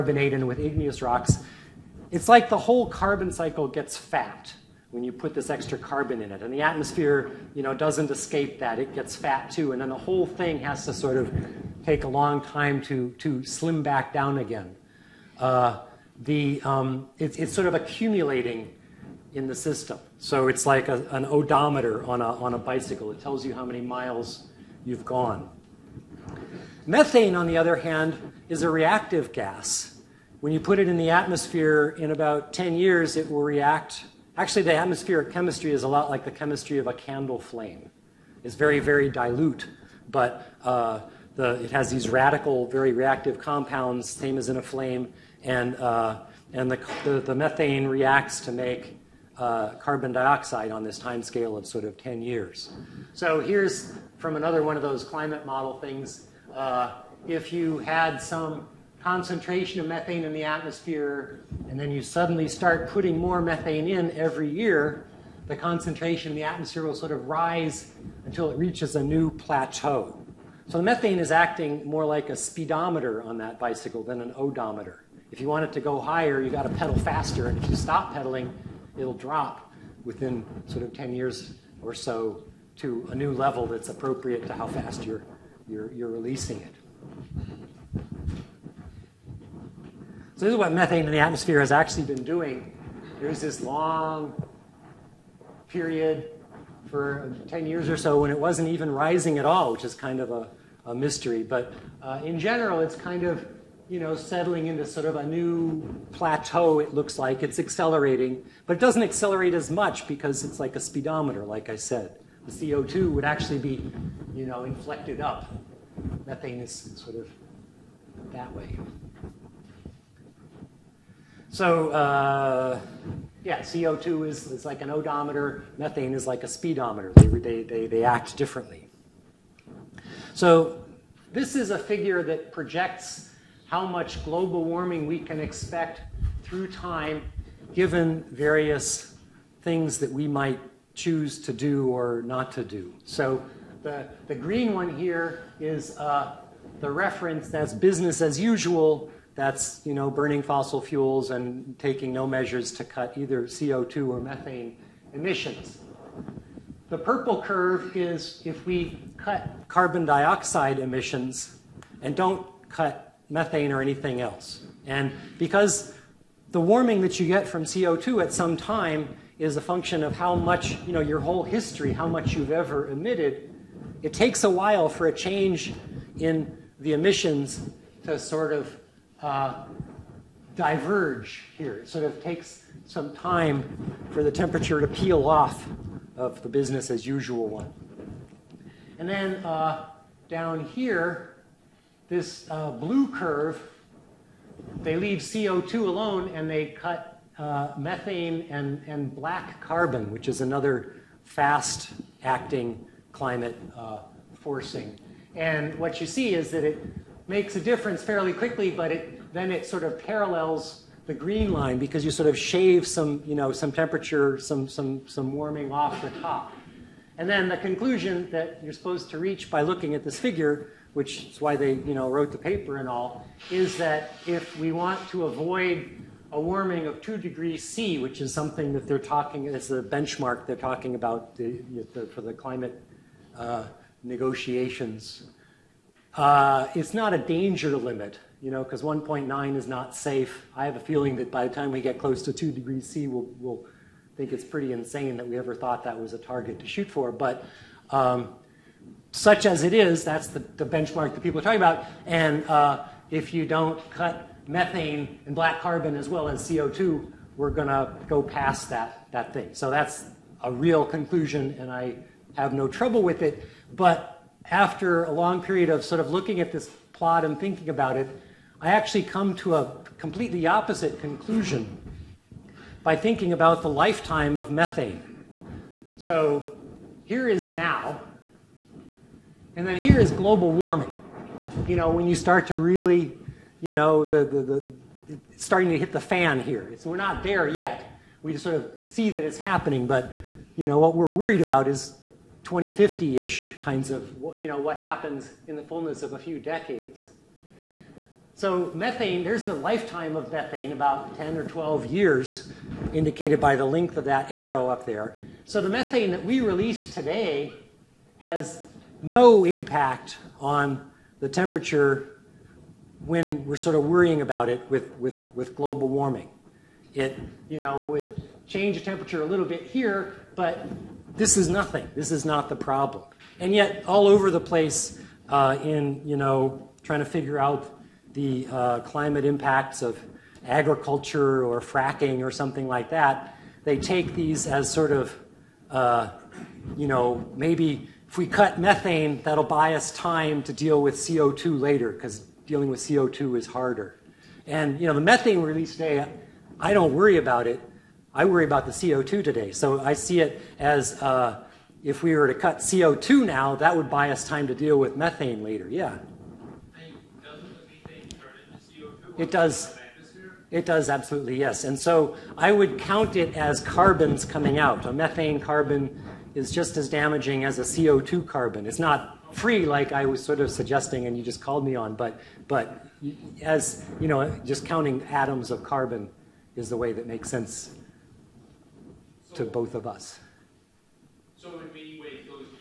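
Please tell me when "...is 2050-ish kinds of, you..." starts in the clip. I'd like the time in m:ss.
4:51.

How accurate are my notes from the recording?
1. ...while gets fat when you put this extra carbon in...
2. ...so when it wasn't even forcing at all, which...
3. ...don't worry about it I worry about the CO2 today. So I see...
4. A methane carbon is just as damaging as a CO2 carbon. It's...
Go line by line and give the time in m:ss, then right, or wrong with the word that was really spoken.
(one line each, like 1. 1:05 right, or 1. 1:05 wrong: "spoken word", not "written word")
1. 0:03 wrong: "cycle", not "while"
2. 1:37 wrong: "rising", not "forcing"
3. 5:46 right
4. 6:04 right.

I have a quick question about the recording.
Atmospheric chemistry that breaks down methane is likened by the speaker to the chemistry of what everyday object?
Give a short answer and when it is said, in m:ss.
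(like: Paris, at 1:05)
A candle flame, at 0:36.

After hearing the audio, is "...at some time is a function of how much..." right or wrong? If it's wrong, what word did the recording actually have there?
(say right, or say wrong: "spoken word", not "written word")
right.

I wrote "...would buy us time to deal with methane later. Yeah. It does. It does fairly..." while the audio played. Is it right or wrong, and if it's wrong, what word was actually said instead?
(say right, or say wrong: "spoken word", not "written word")
wrong: "absolutely", not "fairly".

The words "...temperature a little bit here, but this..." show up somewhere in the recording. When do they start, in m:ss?
5:18.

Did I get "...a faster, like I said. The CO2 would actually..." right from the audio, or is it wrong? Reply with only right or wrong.
wrong.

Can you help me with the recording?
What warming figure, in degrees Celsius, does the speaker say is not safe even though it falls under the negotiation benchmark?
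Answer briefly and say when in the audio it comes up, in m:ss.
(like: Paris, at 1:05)
1.9, at 3:58.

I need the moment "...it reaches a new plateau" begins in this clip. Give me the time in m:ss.
1:08.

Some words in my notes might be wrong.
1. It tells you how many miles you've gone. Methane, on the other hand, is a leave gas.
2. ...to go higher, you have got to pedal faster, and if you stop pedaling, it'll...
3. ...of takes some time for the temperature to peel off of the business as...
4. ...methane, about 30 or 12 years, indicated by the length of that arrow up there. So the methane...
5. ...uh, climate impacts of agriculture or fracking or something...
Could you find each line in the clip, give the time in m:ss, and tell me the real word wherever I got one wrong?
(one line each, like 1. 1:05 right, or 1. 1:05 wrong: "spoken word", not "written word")
1. 0:23 wrong: "reactive", not "leave"
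2. 1:15 right
3. 3:02 right
4. 5:00 wrong: "10", not "30"
5. 5:28 right.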